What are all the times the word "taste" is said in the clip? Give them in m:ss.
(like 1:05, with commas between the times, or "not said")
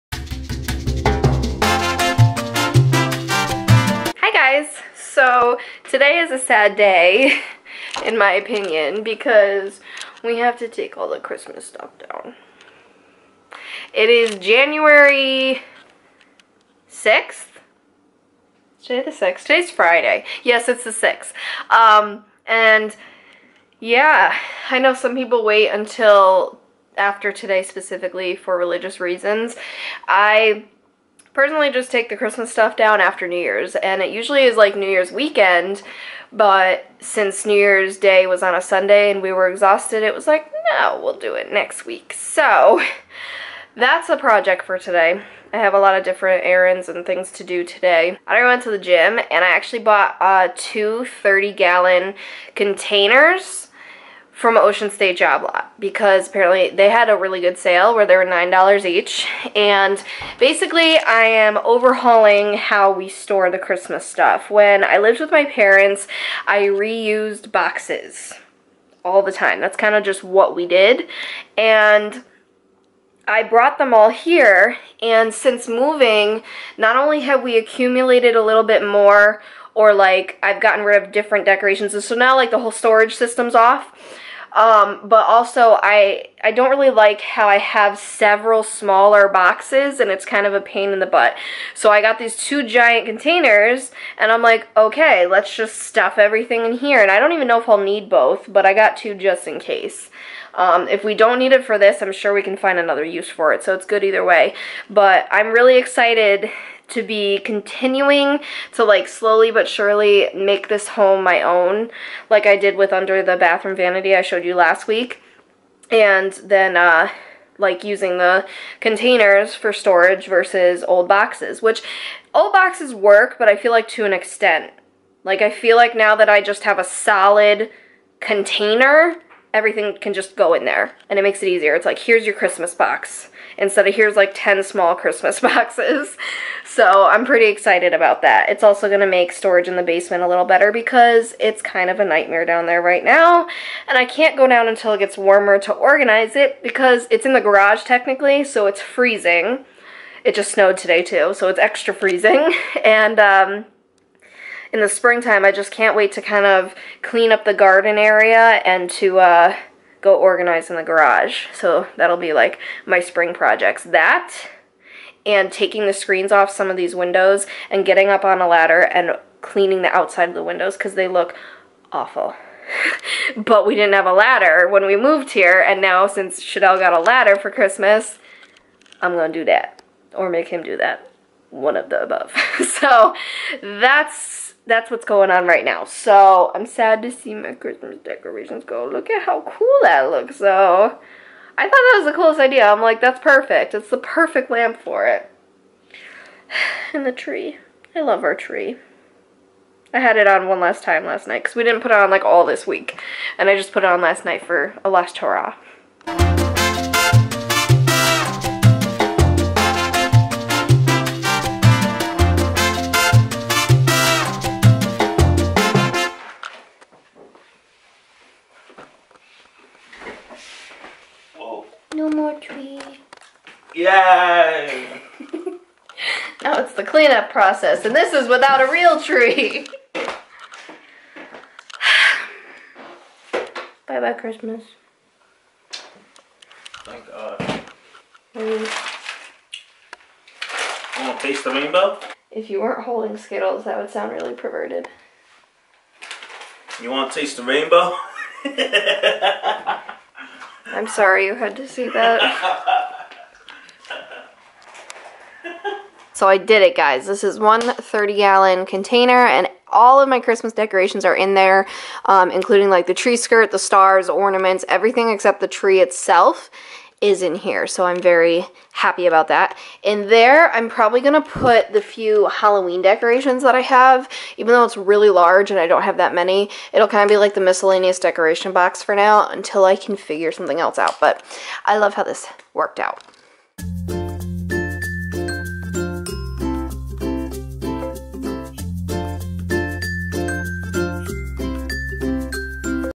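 4:01, 4:07.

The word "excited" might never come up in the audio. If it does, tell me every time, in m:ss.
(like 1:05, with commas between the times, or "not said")
1:45, 2:17.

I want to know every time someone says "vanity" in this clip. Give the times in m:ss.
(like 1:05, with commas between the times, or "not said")
1:53.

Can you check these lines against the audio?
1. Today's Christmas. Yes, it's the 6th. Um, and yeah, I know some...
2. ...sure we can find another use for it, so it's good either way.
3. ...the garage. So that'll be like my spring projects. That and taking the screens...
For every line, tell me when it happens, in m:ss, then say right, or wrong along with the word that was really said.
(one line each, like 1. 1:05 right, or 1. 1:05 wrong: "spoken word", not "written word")
1. 0:19 wrong: "Friday", not "Christmas"
2. 1:42 right
3. 2:40 right.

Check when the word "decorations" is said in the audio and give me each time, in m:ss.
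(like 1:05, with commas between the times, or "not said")
1:21, 3:08, 4:20, 4:32, 4:37.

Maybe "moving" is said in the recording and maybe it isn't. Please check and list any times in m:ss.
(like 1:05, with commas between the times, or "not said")
1:15.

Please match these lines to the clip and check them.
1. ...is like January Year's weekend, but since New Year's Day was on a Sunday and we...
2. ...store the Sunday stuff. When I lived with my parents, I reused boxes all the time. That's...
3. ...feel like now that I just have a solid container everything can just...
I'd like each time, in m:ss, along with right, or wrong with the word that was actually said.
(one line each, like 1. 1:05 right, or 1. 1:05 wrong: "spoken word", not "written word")
1. 0:34 wrong: "New", not "January"
2. 1:03 wrong: "Christmas", not "Sunday"
3. 2:05 right.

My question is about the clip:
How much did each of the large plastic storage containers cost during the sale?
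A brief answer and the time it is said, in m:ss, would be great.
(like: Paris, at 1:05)
$9, at 0:58.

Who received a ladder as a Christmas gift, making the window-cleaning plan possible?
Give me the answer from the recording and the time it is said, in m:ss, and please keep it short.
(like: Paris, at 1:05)
Shadell, at 2:56.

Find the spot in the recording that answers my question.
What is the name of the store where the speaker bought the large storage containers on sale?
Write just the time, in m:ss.
0:54.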